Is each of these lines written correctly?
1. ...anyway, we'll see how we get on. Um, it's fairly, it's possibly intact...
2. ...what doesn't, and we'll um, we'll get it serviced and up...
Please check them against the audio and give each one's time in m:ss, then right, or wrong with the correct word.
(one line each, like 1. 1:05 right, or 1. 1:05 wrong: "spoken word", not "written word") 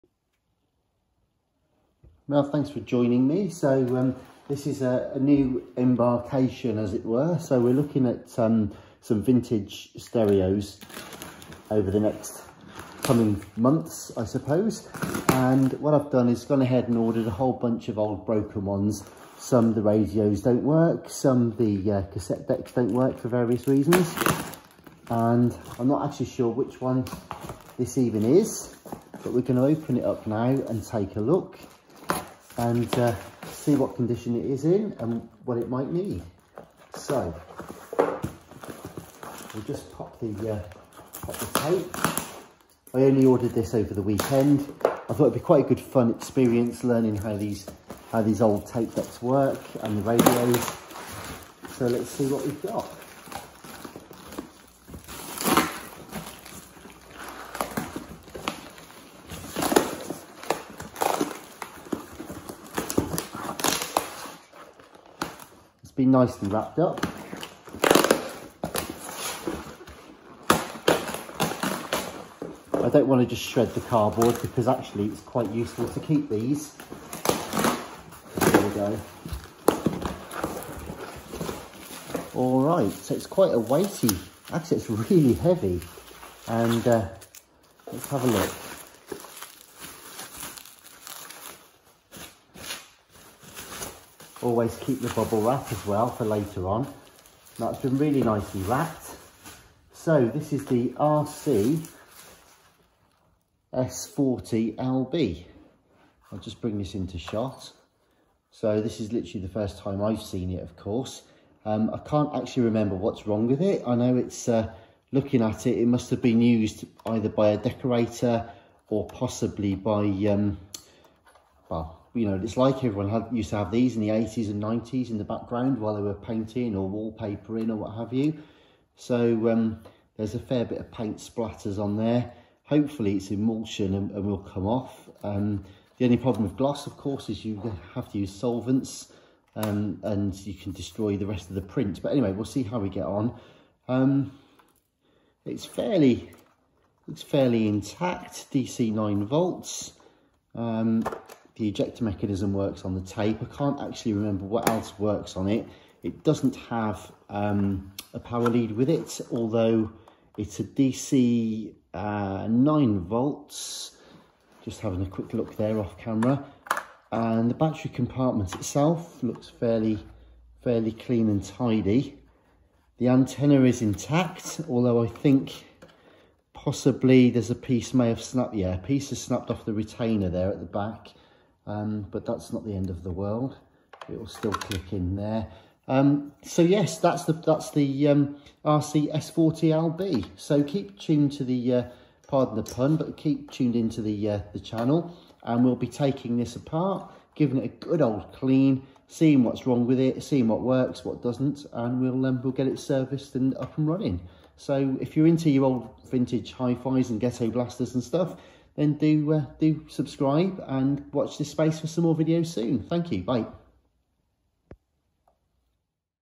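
1. 2:22 wrong: "fairly", not "possibly"
2. 3:21 right.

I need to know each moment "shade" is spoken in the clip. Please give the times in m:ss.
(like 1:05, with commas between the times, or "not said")
not said.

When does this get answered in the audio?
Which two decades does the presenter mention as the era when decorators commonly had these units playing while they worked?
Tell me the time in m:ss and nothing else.
2:04.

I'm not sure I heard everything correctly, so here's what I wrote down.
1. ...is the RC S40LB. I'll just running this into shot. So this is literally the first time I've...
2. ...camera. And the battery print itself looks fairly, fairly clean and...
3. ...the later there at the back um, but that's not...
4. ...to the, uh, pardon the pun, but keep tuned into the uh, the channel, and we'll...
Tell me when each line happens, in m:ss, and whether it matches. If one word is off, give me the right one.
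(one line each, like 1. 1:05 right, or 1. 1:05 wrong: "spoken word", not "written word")
1. 1:40 wrong: "bring", not "running"
2. 2:45 wrong: "compartment", not "print"
3. 2:59 wrong: "retainer", not "later"
4. 3:11 right.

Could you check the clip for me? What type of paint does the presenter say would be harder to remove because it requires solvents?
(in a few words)
Gloss.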